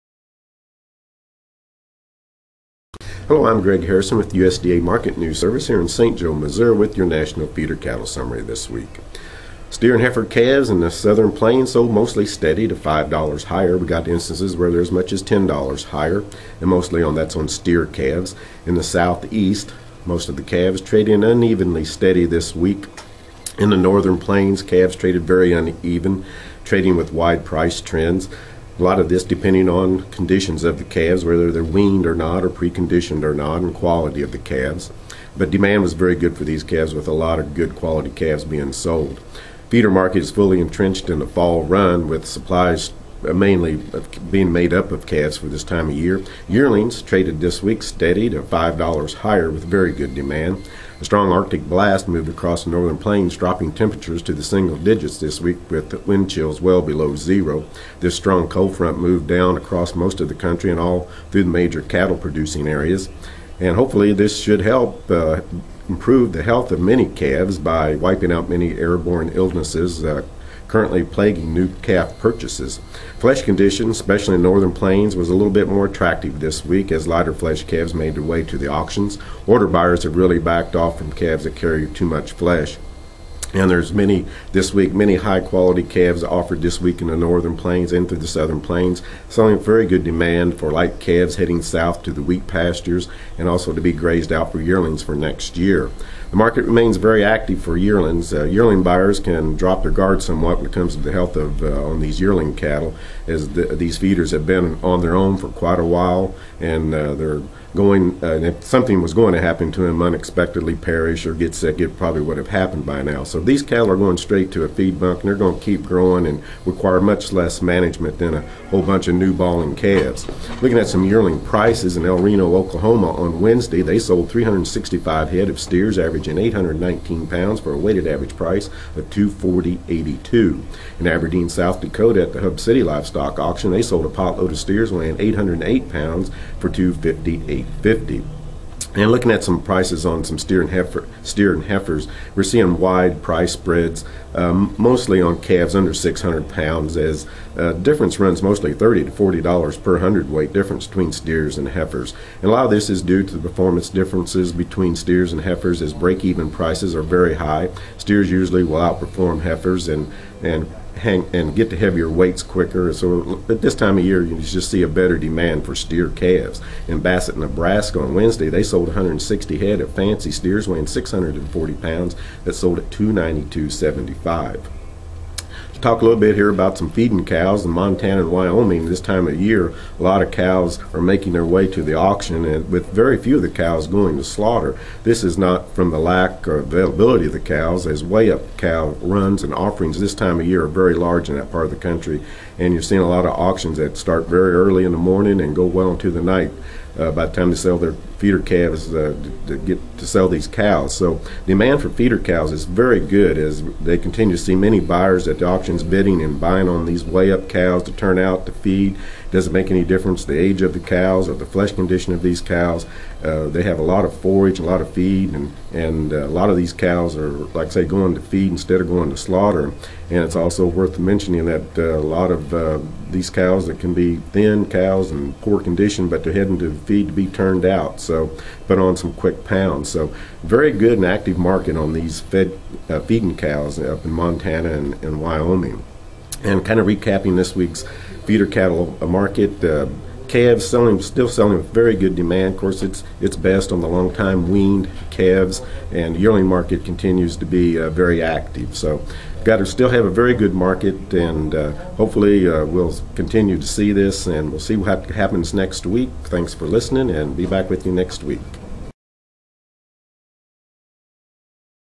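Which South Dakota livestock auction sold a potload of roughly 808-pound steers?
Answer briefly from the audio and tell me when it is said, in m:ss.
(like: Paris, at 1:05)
Hub City Livestock Auction, at 2:12.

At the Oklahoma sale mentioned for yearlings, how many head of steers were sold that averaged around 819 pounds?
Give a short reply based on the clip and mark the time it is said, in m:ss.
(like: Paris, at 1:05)
365, at 2:04.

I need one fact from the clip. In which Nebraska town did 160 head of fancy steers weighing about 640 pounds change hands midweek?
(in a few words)
Bassett.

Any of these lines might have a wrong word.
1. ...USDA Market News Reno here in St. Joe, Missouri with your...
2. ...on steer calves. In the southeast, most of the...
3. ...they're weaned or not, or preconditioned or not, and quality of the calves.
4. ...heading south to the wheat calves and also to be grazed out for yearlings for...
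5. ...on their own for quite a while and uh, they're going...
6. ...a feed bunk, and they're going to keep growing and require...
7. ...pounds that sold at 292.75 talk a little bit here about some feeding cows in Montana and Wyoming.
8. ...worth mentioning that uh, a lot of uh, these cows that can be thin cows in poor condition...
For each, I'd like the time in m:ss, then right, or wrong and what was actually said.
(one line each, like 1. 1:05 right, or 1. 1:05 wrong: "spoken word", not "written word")
1. 0:04 wrong: "Service", not "Reno"
2. 0:17 right
3. 0:31 right
4. 1:31 wrong: "pastures", not "calves"
5. 1:44 right
6. 1:54 right
7. 2:51 right
8. 3:40 right.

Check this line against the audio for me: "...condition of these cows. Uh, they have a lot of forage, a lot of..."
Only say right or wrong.
right.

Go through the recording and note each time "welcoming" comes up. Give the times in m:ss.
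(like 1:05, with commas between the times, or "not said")
not said.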